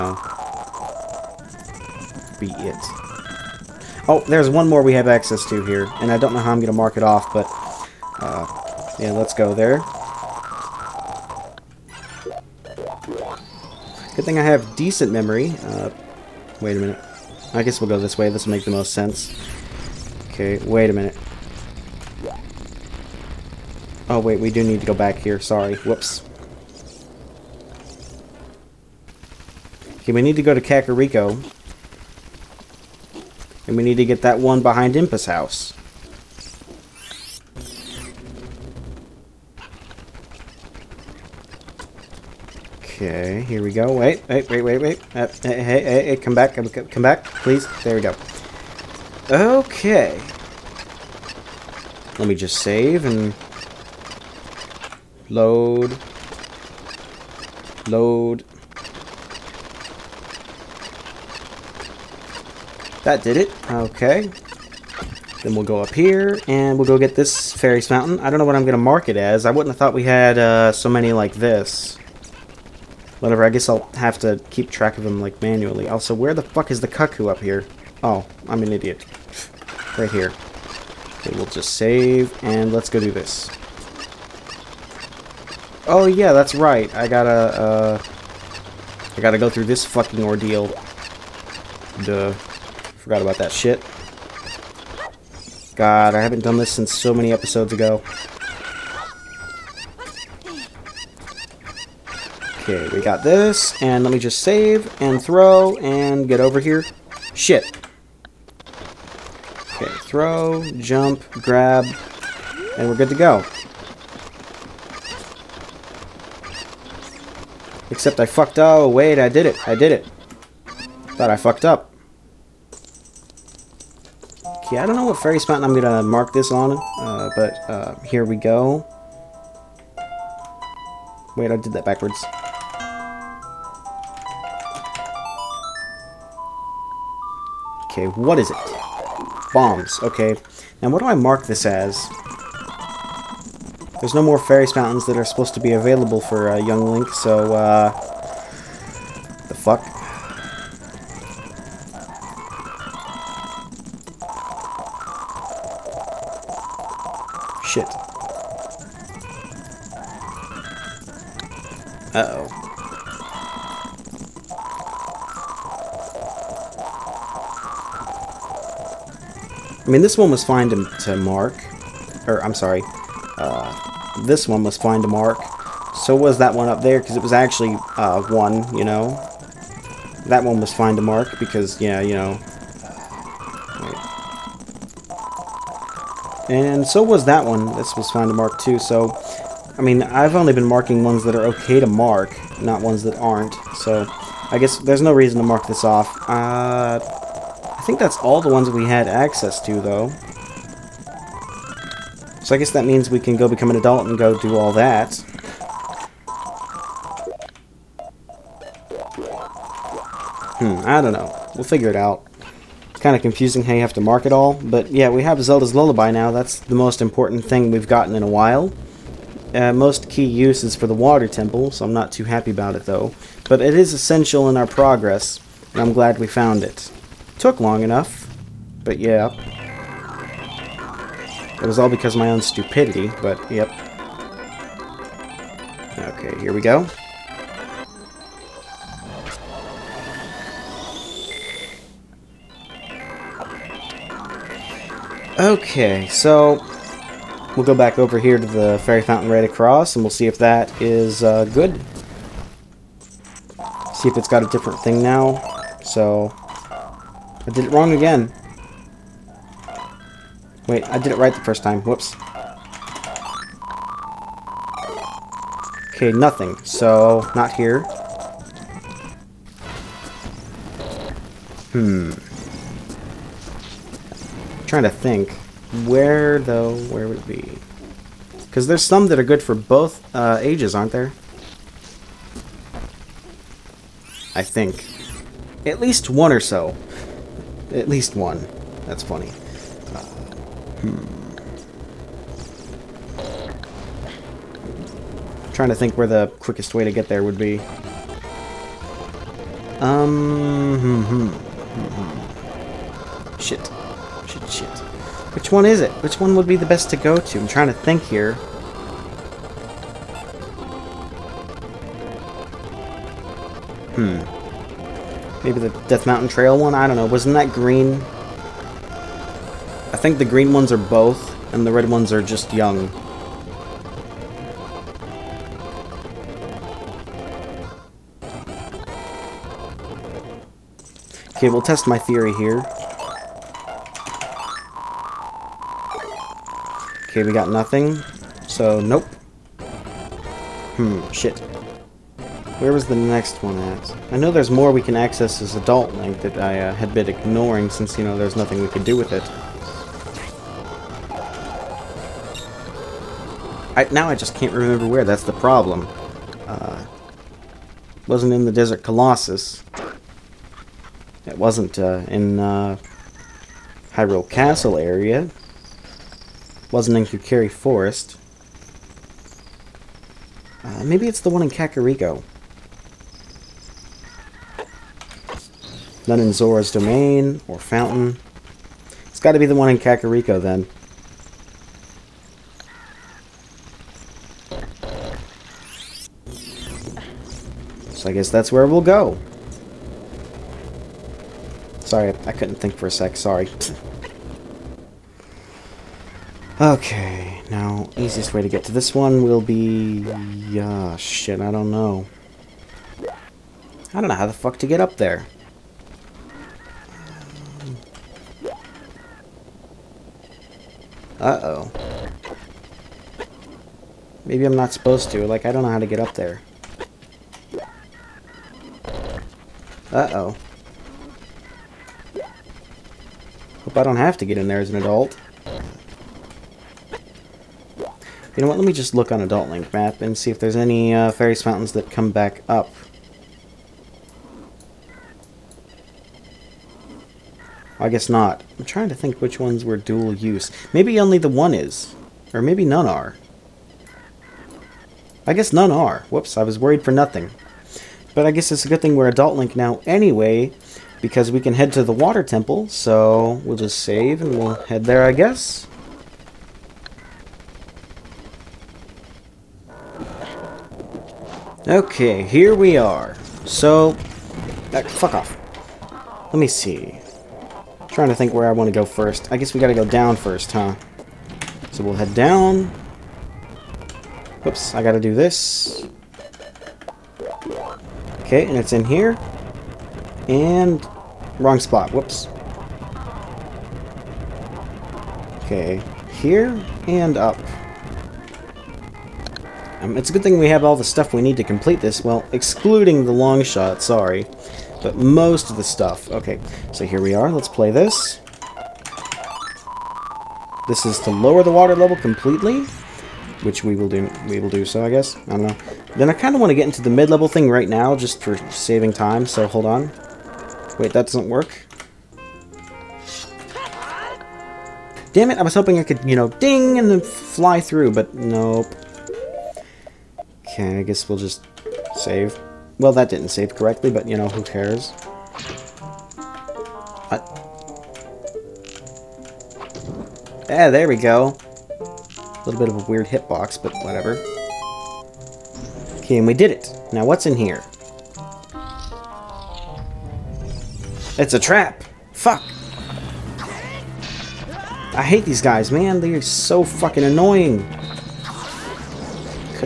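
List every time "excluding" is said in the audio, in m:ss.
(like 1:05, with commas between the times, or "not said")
8:12.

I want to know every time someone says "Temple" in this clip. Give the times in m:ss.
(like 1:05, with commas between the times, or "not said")
3:41, 7:32.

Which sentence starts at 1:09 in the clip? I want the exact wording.
I wouldn't have thought we had uh, so many like this.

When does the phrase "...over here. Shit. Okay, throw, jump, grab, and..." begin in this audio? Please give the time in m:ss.
1:46.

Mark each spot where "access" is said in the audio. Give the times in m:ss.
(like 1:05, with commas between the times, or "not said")
0:05, 3:19, 5:44.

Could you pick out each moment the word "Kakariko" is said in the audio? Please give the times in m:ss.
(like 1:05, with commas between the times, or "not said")
0:30, 6:11, 6:19.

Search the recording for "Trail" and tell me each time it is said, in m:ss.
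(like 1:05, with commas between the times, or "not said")
5:16.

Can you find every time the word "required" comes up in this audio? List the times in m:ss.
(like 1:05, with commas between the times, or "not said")
not said.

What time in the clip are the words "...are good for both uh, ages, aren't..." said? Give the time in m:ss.
4:39.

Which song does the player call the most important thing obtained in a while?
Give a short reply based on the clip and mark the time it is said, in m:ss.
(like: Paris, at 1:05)
Zelda's Lullaby, at 3:35.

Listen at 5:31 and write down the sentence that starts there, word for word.
Okay, we'll test my theory here.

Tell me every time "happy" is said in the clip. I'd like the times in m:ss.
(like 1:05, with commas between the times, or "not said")
3:42.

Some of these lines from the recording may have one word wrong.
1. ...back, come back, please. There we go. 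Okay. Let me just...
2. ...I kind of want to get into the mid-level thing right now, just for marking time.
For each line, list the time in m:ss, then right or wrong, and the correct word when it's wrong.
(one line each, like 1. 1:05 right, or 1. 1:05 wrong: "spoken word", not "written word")
1. 0:46 right
2. 8:26 wrong: "saving", not "marking".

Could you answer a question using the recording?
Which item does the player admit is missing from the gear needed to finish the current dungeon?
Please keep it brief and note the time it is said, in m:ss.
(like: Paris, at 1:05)
long shot, at 8:13.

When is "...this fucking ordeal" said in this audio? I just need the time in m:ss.
1:29.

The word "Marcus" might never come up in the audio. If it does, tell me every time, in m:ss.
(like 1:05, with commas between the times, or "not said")
not said.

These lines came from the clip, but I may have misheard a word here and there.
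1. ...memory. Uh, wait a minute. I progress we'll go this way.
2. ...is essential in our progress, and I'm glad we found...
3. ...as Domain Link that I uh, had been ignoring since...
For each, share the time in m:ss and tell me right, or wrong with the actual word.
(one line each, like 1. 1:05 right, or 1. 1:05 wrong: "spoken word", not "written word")
1. 0:15 wrong: "guess", not "progress"
2. 3:43 right
3. 5:45 wrong: "Adult", not "Domain".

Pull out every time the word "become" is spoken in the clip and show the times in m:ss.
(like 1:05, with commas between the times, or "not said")
3:23.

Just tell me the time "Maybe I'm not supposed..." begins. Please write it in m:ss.
6:54.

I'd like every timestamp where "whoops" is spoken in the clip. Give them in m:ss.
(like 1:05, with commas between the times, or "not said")
0:25, 4:21, 7:26, 7:54, 8:01.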